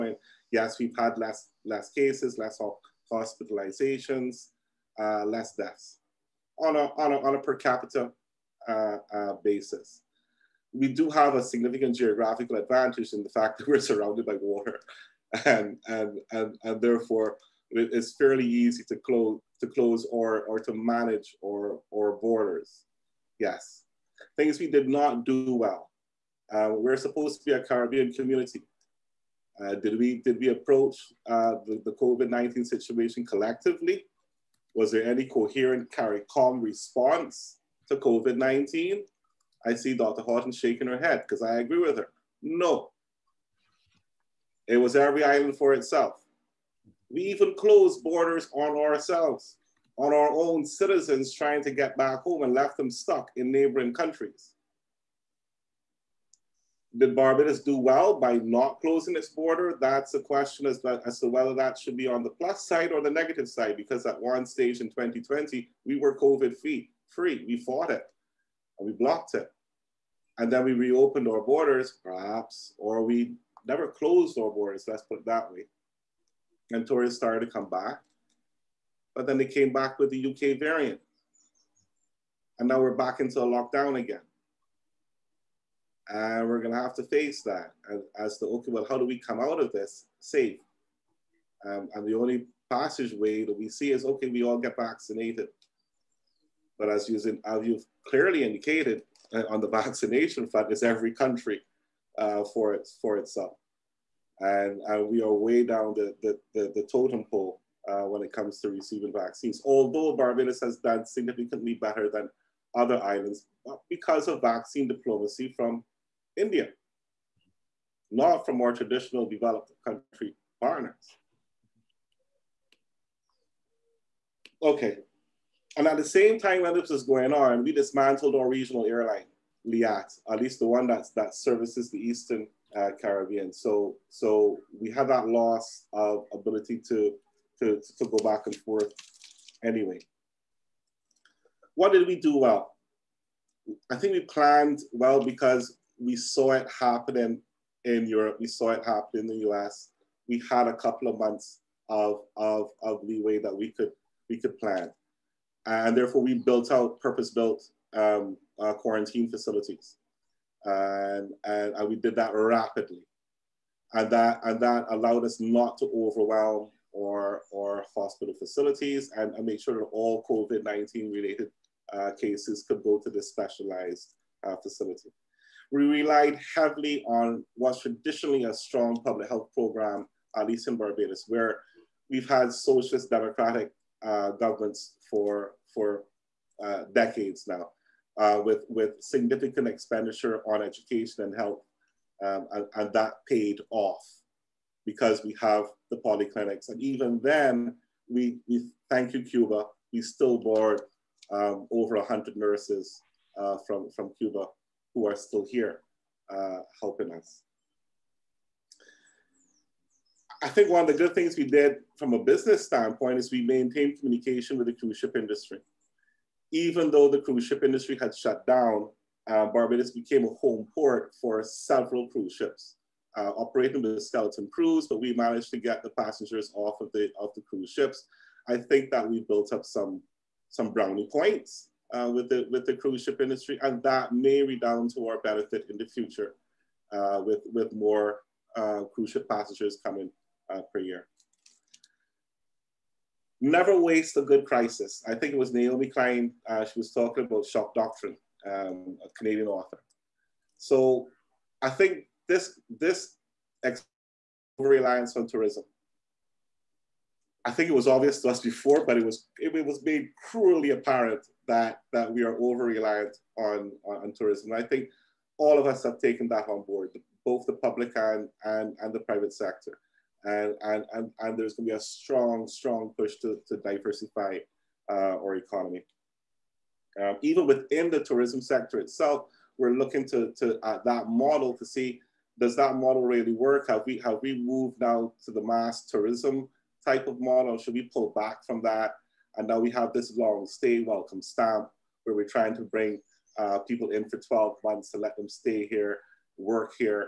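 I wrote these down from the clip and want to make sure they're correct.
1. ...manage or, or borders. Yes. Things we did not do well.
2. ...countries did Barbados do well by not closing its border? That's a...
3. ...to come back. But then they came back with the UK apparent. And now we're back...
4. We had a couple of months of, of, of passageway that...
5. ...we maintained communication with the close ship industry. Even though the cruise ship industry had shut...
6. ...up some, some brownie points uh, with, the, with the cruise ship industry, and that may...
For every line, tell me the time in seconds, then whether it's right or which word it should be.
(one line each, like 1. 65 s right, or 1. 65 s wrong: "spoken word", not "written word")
1. 20 s right
2. 53 s right
3. 77 s wrong: "variant", not "apparent"
4. 150 s wrong: "leeway", not "passageway"
5. 213 s wrong: "cruise", not "close"
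6. 229 s right.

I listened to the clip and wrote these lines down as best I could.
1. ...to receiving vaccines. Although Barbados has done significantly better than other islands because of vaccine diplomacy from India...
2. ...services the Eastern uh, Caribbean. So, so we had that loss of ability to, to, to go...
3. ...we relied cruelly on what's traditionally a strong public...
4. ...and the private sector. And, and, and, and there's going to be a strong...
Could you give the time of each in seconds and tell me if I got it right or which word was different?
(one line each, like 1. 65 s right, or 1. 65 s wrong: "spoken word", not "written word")
1. 108 s right
2. 131 s right
3. 175 s wrong: "heavily", not "cruelly"
4. 268 s right.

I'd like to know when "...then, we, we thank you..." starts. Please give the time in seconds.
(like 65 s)
197 s.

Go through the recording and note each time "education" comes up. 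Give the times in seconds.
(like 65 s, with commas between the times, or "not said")
190 s.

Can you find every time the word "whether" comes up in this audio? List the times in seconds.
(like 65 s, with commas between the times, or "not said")
61 s.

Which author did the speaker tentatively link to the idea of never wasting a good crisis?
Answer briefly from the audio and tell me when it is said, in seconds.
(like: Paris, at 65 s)
Naomi Klein, at 245 s.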